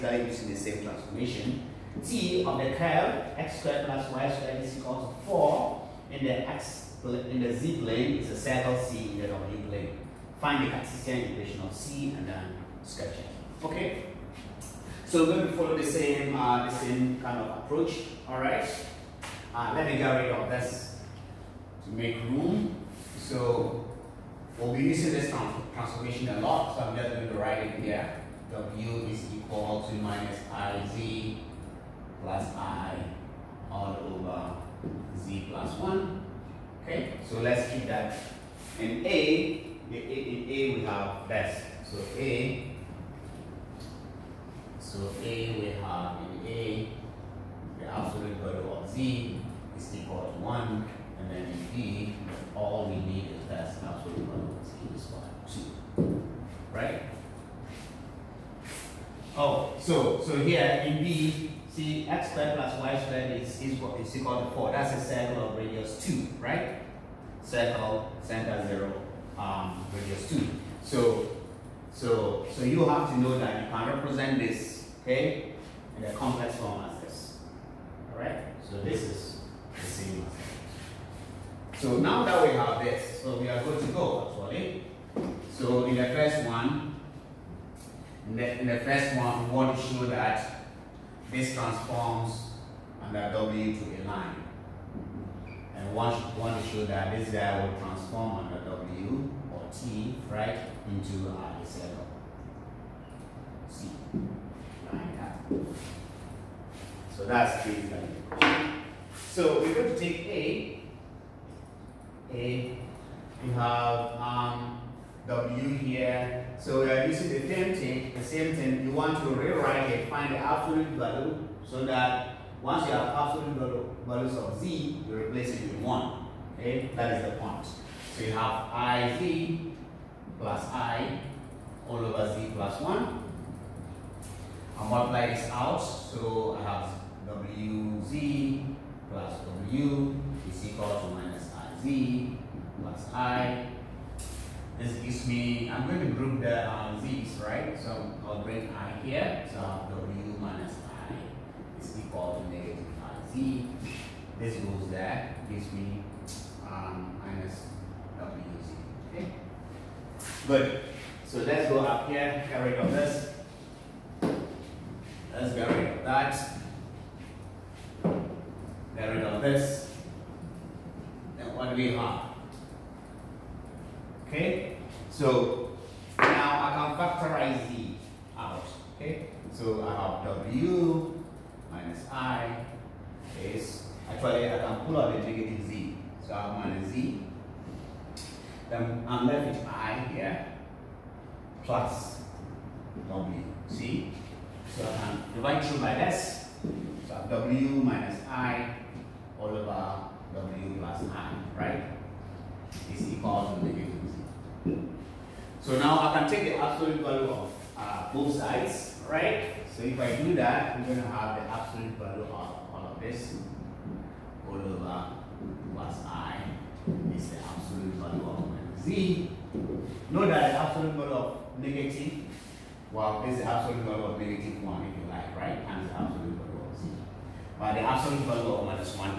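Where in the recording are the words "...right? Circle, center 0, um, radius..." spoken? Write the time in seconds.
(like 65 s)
66 s.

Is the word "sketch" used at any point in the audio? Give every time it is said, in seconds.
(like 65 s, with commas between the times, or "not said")
12 s.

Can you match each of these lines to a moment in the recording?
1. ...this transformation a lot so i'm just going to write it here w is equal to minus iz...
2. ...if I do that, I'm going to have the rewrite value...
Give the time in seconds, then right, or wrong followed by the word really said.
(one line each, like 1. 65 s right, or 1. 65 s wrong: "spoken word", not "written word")
1. 25 s right
2. 209 s wrong: "absolute", not "rewrite".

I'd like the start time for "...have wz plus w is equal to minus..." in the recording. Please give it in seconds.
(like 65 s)
136 s.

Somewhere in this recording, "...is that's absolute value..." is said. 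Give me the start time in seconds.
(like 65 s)
53 s.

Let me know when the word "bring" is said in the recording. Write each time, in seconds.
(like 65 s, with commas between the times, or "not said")
148 s.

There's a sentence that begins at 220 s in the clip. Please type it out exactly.
Note that the absolute value of negative, well, this is the absolute value of negative 1 if you like, right?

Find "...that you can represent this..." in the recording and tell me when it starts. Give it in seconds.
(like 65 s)
73 s.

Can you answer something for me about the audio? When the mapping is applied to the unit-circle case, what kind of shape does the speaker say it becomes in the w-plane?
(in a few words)
a line.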